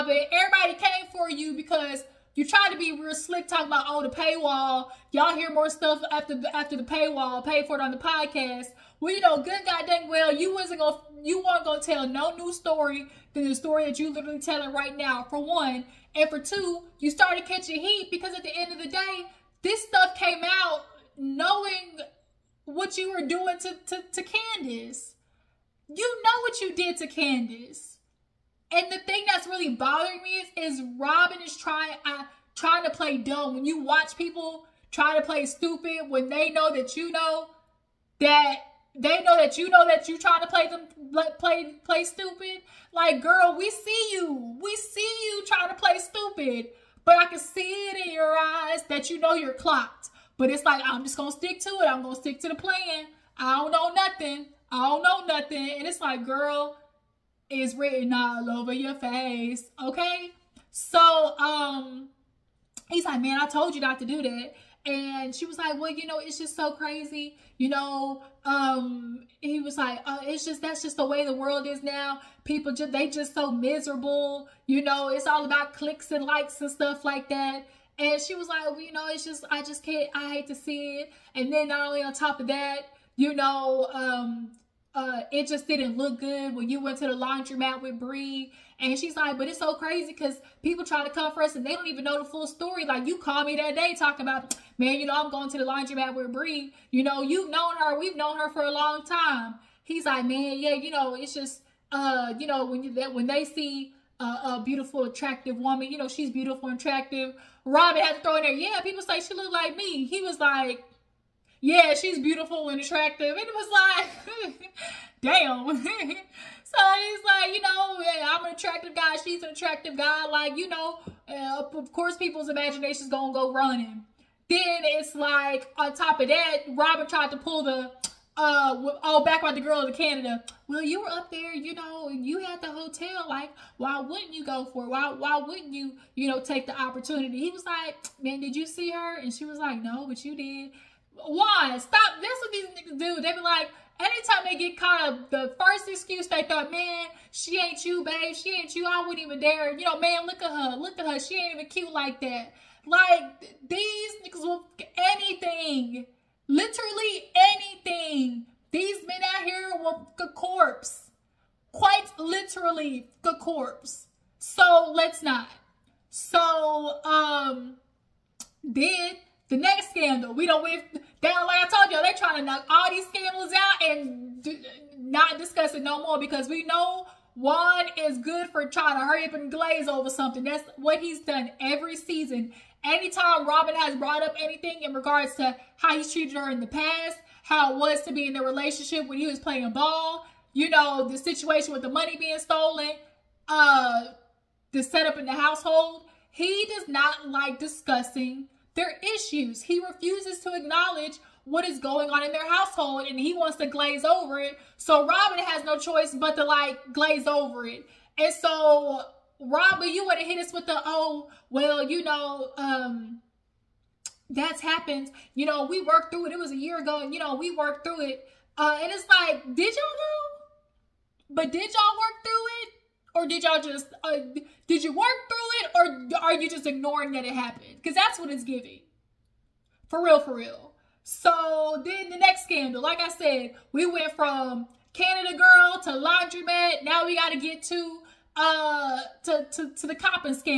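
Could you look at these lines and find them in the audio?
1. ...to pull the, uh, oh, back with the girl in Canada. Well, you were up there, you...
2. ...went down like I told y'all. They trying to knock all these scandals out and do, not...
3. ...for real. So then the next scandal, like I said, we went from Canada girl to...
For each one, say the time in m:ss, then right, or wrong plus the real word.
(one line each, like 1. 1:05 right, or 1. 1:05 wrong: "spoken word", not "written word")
1. 2:07 right
2. 2:50 right
3. 3:50 right.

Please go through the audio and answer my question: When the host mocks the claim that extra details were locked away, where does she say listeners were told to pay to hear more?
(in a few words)
the podcast.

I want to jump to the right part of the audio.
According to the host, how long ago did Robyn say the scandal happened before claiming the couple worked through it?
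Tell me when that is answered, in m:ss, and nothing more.
3:36.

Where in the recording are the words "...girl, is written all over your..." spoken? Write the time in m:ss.
0:56.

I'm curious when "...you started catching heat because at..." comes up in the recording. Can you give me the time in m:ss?
0:16.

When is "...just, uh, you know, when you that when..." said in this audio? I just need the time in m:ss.
1:41.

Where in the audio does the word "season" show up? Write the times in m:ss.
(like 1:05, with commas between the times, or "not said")
3:01.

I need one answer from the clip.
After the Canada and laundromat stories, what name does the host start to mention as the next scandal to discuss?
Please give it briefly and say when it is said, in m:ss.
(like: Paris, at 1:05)
Coppin, at 3:59.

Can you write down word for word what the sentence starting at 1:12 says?
People just, they just so miserable.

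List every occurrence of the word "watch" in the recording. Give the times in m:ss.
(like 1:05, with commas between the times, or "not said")
0:33.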